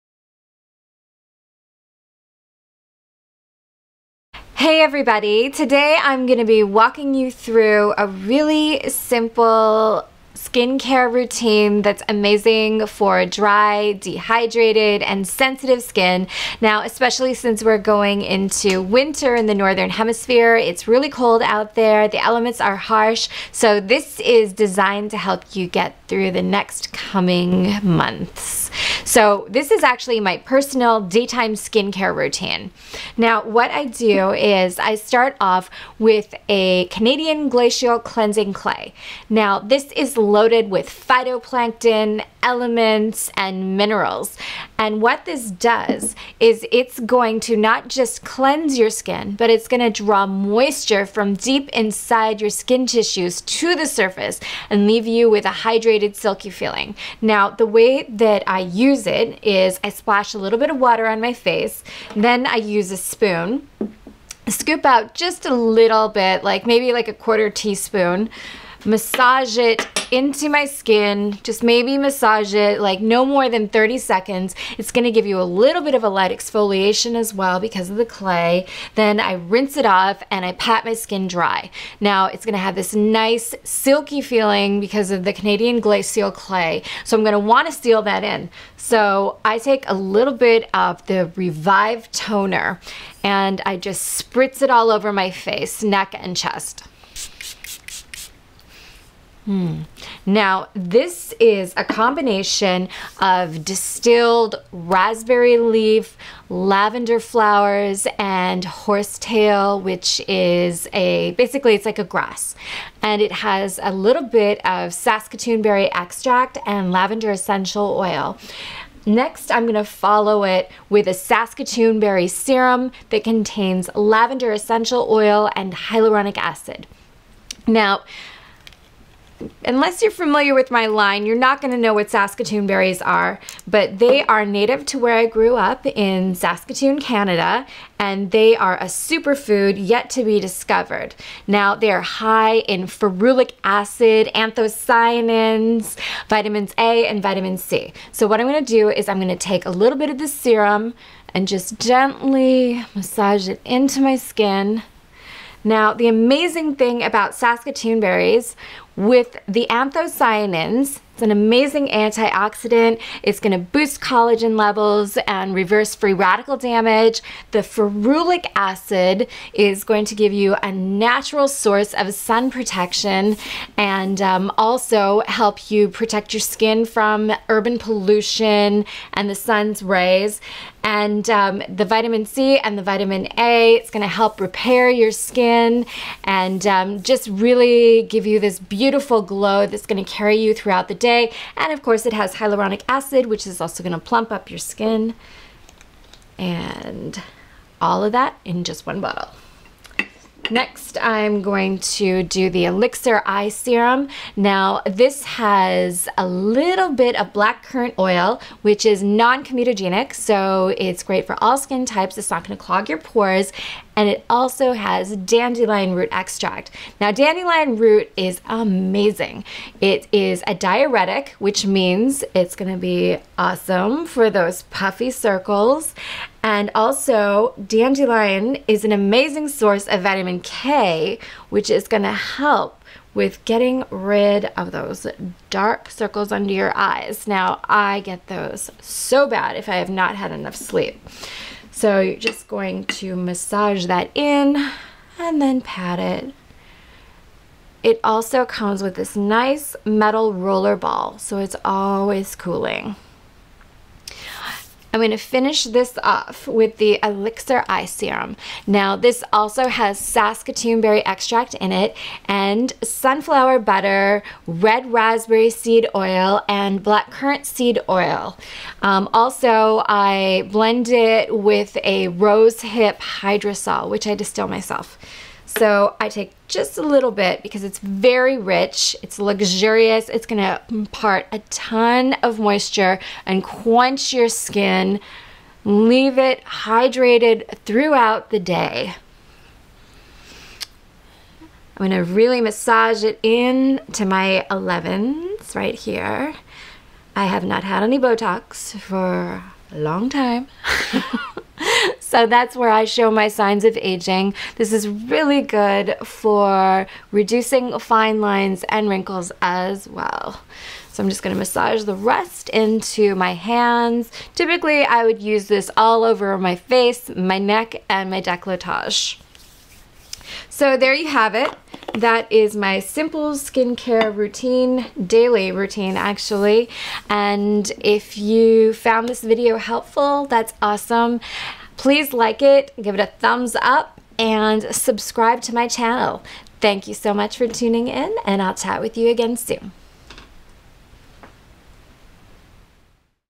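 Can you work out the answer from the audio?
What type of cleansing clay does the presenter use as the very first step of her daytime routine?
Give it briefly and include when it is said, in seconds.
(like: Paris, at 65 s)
Canadian Glacial Cleansing Clay, at 36 s.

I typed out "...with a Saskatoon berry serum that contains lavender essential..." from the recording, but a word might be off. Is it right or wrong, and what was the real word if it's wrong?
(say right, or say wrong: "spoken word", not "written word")
right.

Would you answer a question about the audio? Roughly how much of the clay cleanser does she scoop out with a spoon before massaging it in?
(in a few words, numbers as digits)
a quarter teaspoon.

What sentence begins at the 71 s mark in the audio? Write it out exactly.
Just maybe massage it like no more than 30 seconds.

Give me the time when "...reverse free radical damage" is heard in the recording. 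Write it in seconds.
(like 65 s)
165 s.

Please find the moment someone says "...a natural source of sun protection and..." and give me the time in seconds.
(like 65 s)
170 s.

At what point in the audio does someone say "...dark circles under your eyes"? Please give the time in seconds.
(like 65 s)
235 s.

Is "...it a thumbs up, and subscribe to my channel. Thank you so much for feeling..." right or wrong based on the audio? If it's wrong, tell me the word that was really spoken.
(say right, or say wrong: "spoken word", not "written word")
wrong: "tuning", not "feeling".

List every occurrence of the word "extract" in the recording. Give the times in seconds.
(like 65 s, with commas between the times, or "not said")
115 s, 216 s, 261 s.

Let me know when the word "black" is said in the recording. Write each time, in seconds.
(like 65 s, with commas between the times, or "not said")
207 s, 266 s.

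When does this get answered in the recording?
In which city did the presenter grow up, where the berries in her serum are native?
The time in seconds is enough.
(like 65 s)
136 s.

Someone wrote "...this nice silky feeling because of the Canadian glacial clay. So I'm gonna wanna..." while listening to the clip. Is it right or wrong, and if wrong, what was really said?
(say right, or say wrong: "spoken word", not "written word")
right.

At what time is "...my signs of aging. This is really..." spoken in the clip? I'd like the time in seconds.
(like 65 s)
303 s.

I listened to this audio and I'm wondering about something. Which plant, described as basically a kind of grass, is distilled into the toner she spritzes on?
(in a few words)
horsetail.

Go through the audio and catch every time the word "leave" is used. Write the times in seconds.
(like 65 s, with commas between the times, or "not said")
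54 s, 285 s.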